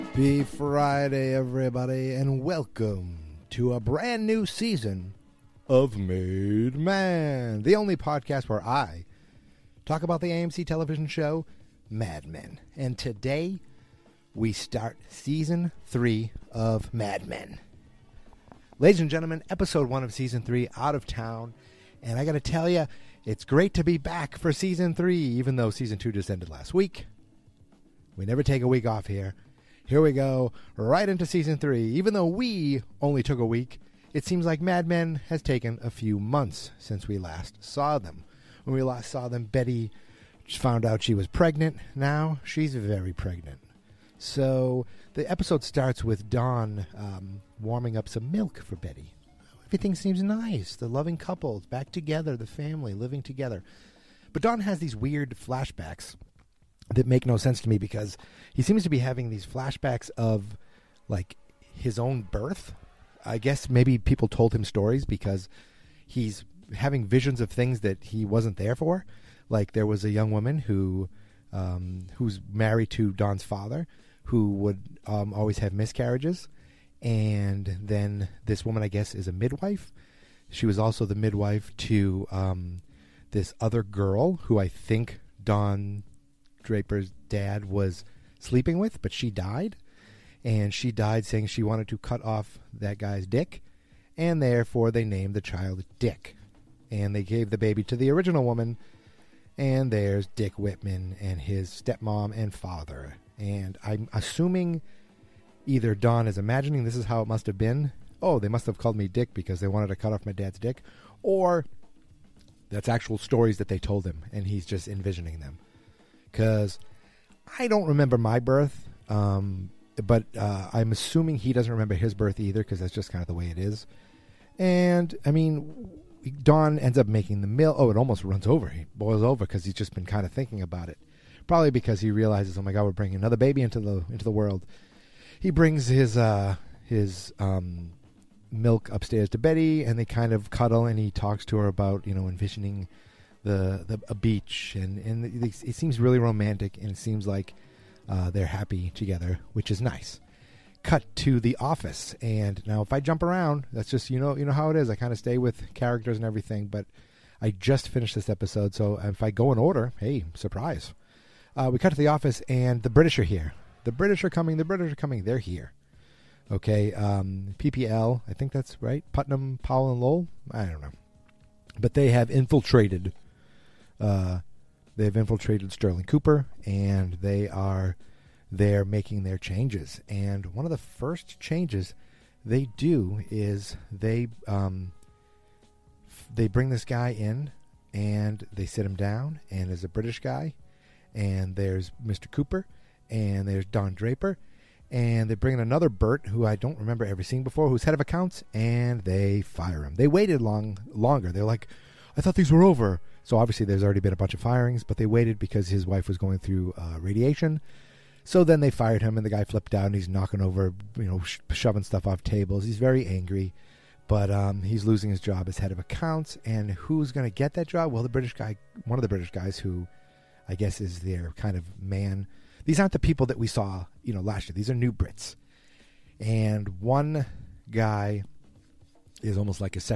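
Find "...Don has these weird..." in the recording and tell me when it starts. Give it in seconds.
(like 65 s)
54 s.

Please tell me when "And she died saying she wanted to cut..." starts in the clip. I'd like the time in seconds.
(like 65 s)
90 s.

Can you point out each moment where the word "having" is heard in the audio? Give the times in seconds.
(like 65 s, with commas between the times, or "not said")
58 s, 66 s.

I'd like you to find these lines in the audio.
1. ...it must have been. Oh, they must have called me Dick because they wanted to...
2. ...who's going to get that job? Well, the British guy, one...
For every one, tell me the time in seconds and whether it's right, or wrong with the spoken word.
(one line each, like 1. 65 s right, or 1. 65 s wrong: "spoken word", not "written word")
1. 107 s right
2. 216 s right.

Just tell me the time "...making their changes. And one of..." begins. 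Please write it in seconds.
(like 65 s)
178 s.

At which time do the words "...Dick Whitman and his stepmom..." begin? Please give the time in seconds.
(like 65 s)
100 s.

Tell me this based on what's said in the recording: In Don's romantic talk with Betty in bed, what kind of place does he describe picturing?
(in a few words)
A beach.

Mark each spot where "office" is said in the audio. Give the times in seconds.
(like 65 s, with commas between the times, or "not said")
151 s, 162 s.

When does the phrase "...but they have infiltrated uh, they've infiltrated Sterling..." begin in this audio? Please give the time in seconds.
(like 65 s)
171 s.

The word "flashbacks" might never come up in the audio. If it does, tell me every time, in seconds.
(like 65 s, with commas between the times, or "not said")
55 s, 59 s.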